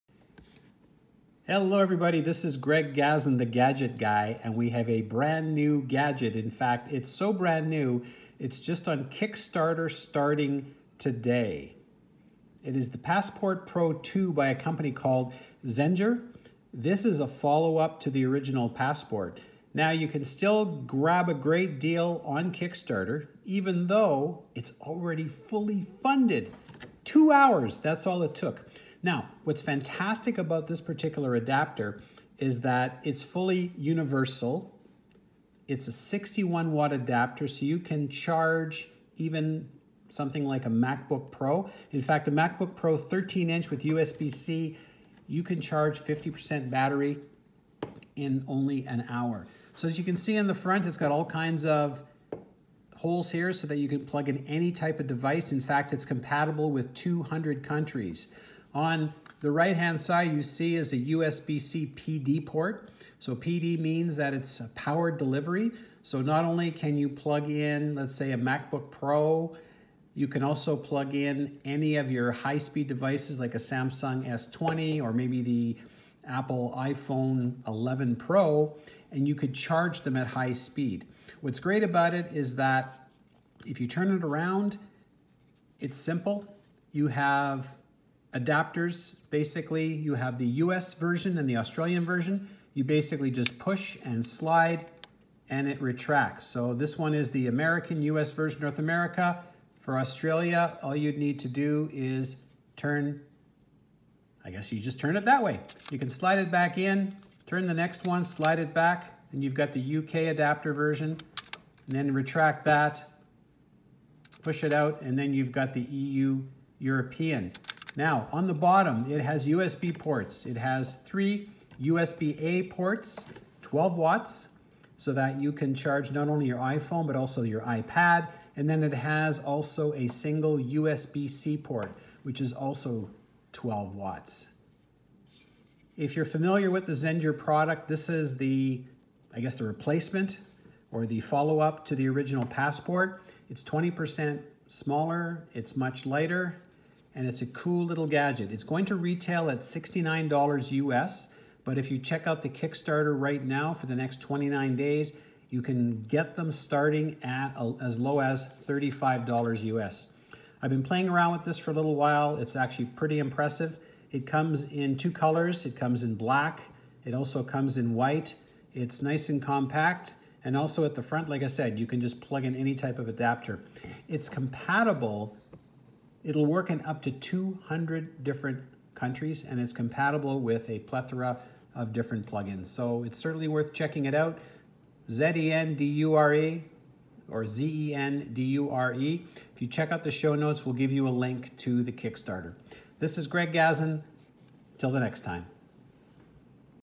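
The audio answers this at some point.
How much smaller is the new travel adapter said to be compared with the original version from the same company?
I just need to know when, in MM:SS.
02:23.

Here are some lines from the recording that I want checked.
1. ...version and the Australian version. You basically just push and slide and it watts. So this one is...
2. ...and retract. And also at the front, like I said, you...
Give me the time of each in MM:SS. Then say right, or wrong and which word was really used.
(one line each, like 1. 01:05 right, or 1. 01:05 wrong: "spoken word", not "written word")
1. 01:30 wrong: "retracts", not "watts"
2. 02:49 wrong: "compact", not "retract".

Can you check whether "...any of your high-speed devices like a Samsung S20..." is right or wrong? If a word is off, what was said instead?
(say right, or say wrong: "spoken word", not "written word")
right.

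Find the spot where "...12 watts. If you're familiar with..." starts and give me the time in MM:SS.
02:13.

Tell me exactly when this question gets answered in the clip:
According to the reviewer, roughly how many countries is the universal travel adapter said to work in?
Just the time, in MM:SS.
00:56.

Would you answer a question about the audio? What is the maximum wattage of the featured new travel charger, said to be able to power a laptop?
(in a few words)
61 watt.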